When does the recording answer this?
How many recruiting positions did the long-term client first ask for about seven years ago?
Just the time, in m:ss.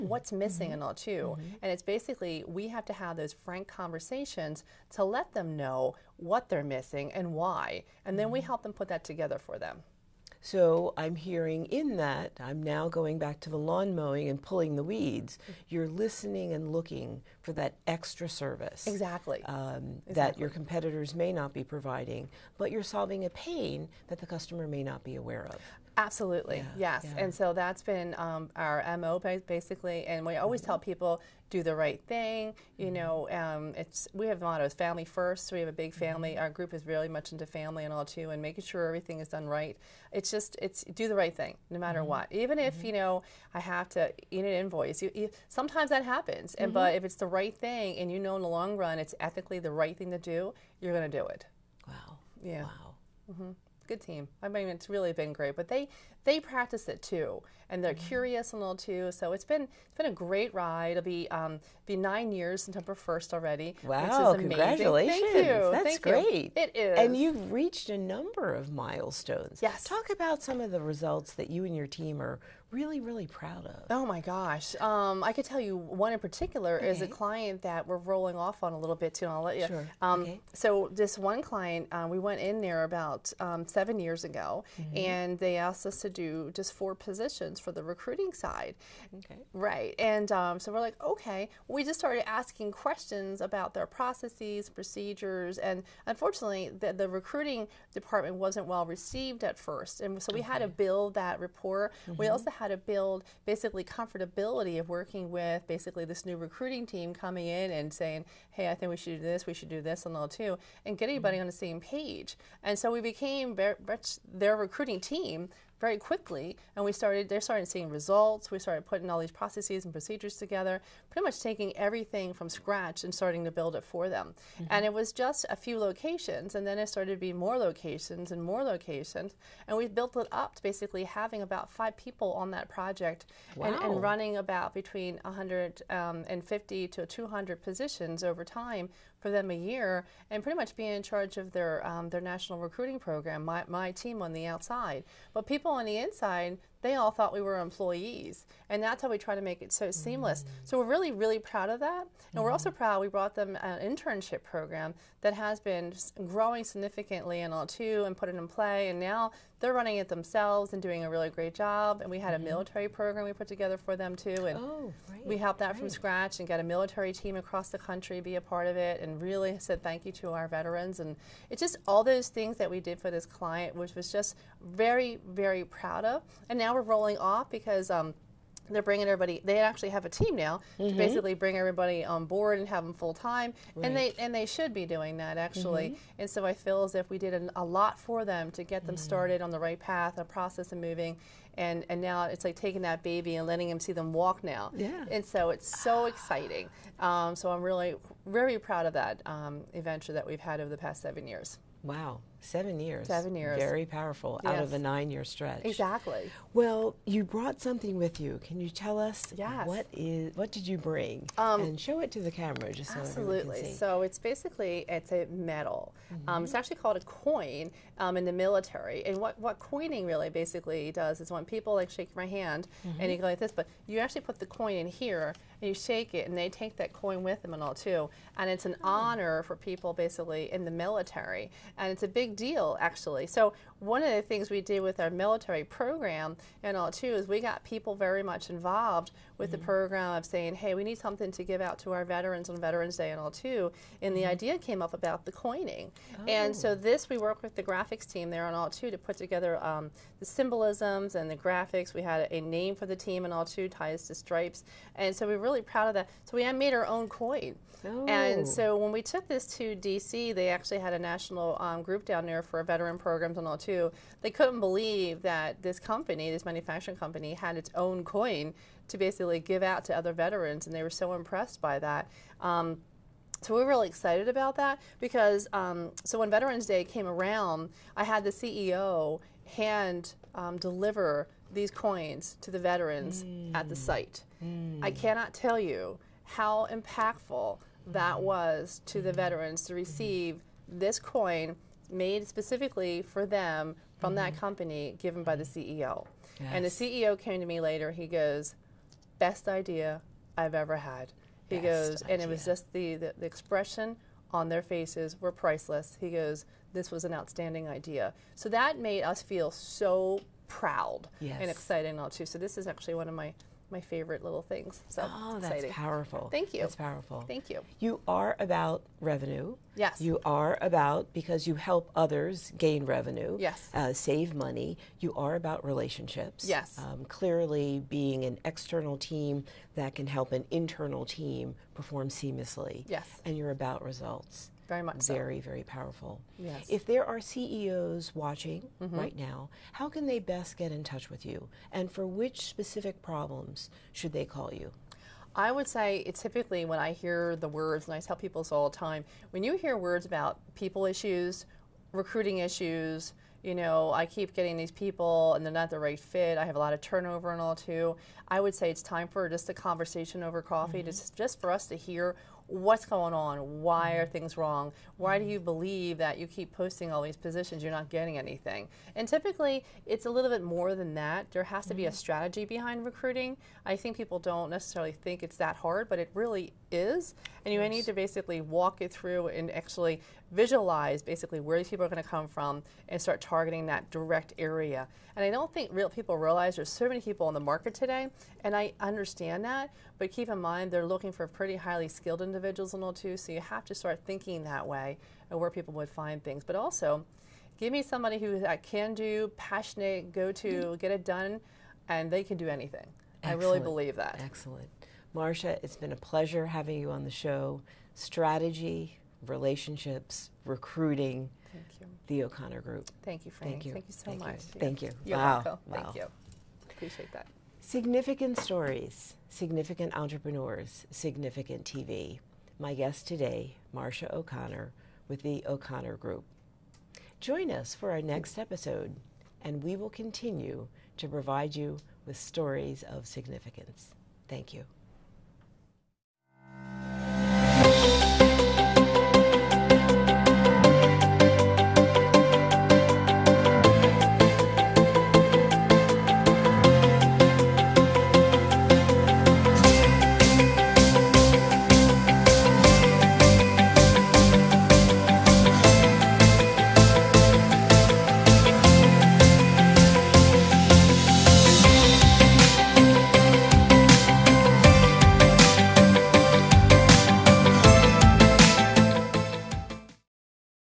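1:26.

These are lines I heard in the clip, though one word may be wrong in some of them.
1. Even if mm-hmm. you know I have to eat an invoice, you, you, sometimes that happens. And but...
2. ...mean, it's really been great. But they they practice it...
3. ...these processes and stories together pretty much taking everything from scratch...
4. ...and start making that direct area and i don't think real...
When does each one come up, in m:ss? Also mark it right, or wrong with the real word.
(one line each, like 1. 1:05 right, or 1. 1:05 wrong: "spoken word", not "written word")
1. 0:42 right
2. 0:54 right
3. 1:59 wrong: "procedures", not "stories"
4. 6:22 wrong: "targeting", not "making".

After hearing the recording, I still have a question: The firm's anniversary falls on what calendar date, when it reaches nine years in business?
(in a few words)
September 1.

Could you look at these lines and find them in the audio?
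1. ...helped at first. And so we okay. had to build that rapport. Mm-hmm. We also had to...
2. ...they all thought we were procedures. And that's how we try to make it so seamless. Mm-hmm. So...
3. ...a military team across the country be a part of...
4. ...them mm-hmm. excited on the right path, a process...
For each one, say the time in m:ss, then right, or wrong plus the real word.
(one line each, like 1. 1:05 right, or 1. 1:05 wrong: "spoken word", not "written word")
1. 1:38 wrong: "received", not "helped"
2. 2:26 wrong: "employees", not "procedures"
3. 2:46 right
4. 3:08 wrong: "started", not "excited".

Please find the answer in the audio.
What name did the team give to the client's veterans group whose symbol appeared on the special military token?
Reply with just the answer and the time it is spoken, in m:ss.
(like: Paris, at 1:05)
ties to stripes, at 4:13.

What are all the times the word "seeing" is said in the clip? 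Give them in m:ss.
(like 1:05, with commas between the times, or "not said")
1:57.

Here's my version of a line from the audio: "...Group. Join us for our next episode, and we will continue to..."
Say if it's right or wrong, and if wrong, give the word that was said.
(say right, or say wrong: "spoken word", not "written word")
right.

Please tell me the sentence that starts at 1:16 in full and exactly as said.
is a client that we're rolling off on a little bit too, and I'll let you.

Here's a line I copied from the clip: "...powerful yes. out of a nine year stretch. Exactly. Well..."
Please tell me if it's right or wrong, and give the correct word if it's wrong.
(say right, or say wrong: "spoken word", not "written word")
right.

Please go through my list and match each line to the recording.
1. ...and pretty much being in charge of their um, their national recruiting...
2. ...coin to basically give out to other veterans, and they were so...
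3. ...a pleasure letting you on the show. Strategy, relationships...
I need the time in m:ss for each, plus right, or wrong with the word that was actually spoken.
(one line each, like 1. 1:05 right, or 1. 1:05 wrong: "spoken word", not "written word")
1. 2:20 right
2. 4:28 right
3. 6:45 wrong: "having", not "letting".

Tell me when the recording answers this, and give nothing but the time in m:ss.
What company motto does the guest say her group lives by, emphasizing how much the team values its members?
0:34.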